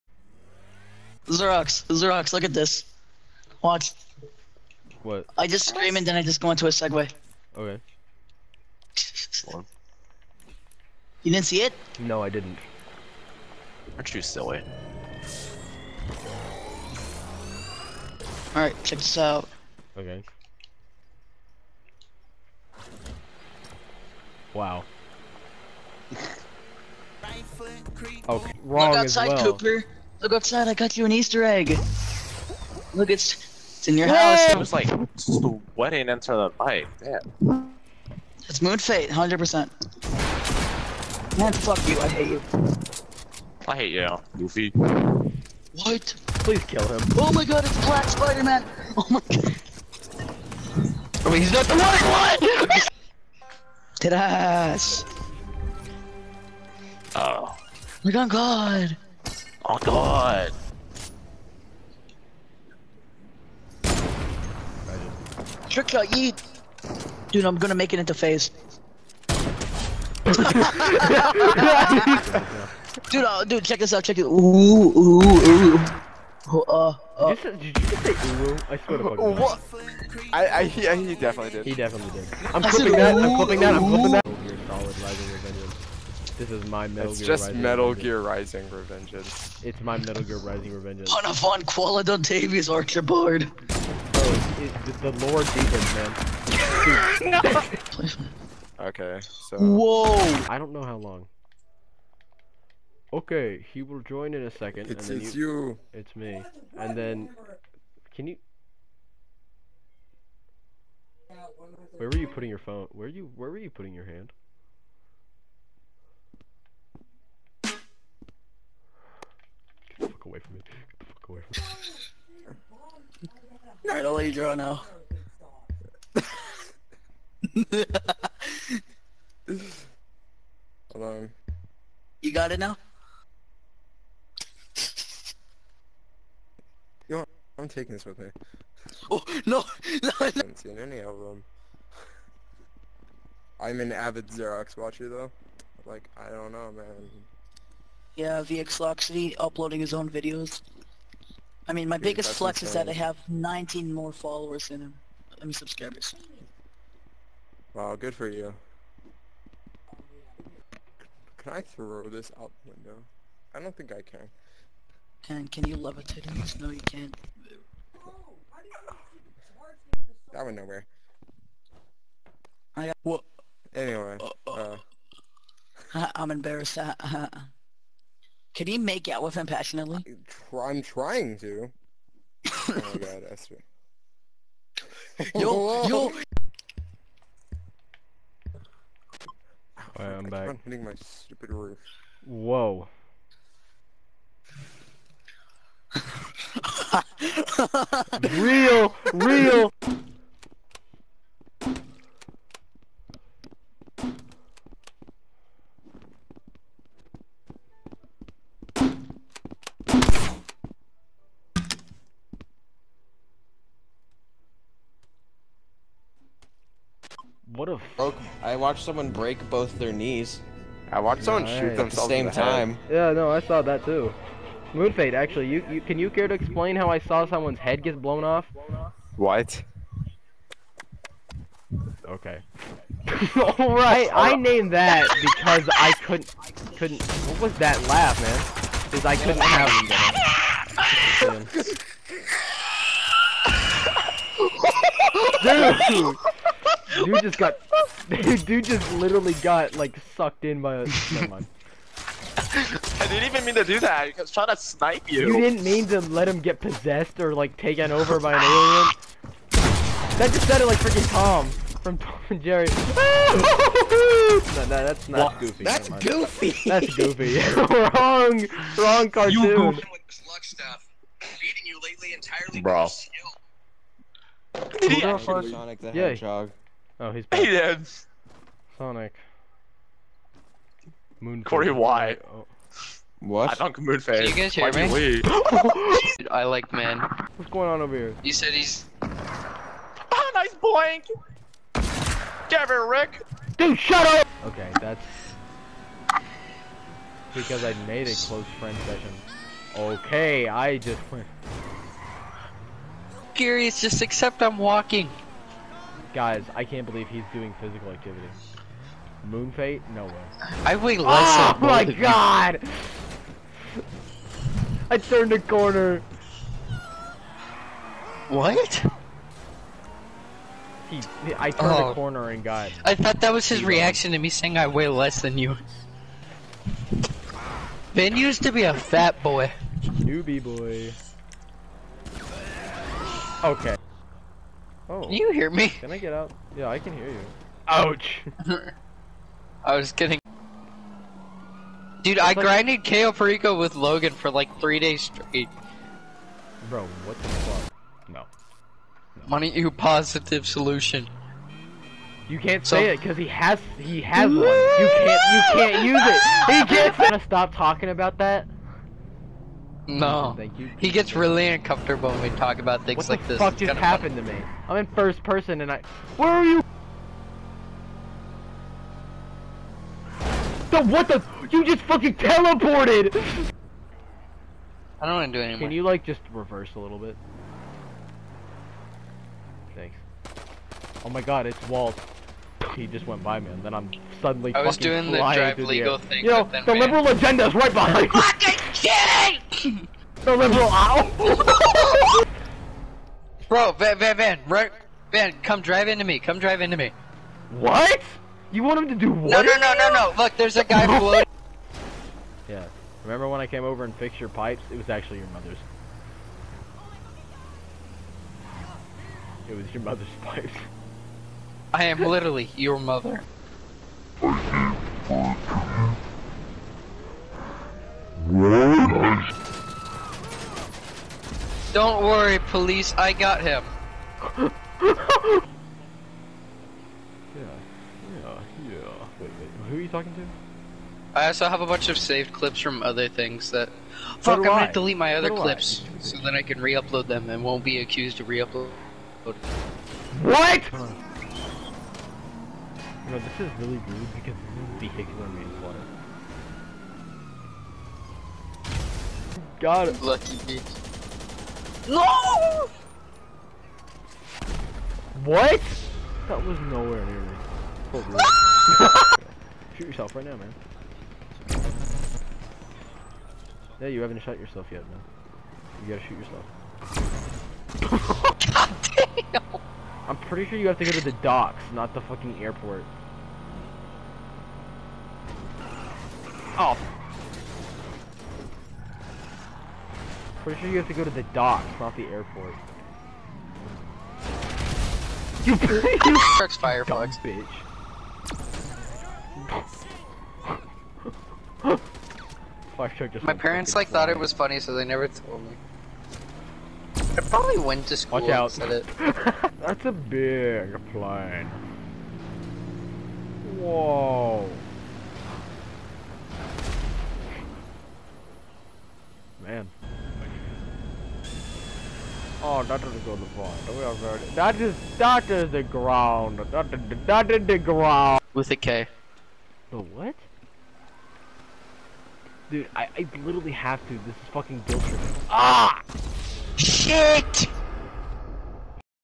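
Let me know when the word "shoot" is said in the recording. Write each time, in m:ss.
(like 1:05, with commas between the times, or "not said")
3:41, 7:39, 7:46.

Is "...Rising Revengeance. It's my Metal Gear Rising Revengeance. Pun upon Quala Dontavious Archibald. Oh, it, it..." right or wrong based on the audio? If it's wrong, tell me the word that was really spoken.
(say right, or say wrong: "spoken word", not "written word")
right.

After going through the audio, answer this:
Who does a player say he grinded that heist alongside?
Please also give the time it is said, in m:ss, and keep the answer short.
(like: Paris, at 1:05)
Logan, at 5:43.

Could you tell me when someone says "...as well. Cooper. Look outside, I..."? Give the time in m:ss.
0:29.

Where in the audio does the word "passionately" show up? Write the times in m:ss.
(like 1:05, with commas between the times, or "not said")
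2:59.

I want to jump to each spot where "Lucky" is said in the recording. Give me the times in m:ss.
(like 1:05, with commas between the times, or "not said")
7:30.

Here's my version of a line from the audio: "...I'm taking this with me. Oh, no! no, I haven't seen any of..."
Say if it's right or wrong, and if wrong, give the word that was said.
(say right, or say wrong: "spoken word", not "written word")
right.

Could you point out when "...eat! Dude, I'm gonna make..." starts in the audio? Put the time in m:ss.
1:06.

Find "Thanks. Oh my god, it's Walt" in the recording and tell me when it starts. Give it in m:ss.
6:19.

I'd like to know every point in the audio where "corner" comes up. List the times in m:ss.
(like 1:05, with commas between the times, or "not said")
5:15, 5:21.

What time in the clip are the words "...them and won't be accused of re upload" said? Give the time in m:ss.
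7:17.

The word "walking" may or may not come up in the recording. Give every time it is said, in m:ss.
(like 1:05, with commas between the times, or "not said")
5:04.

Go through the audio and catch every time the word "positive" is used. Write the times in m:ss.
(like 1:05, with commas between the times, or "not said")
5:49.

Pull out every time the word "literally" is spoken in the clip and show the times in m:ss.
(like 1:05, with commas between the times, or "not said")
4:08, 6:52, 8:43.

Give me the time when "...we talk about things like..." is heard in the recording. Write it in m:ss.
6:02.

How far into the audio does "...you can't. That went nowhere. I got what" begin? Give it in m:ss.
2:46.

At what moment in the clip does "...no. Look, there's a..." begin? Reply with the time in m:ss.
6:39.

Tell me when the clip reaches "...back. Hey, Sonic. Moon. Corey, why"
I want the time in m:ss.
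4:37.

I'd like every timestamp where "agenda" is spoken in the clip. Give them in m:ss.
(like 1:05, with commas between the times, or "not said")
6:27.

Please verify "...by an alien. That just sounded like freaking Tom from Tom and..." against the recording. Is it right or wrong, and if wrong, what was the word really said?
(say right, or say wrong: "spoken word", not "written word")
right.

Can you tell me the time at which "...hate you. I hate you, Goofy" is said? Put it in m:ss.
0:42.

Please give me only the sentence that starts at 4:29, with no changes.
You stuff, Beating you lately entirely Bro.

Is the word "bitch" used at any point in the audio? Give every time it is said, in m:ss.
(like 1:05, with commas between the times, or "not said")
7:30, 8:07.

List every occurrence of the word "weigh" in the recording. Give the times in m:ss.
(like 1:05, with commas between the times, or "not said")
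5:10, 5:24.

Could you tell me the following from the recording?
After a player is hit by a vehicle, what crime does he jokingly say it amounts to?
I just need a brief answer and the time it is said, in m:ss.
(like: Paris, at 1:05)
vehicular manslaughter, at 7:24.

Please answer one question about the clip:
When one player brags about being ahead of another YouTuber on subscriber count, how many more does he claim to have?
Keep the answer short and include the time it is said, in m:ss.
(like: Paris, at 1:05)
19, at 2:33.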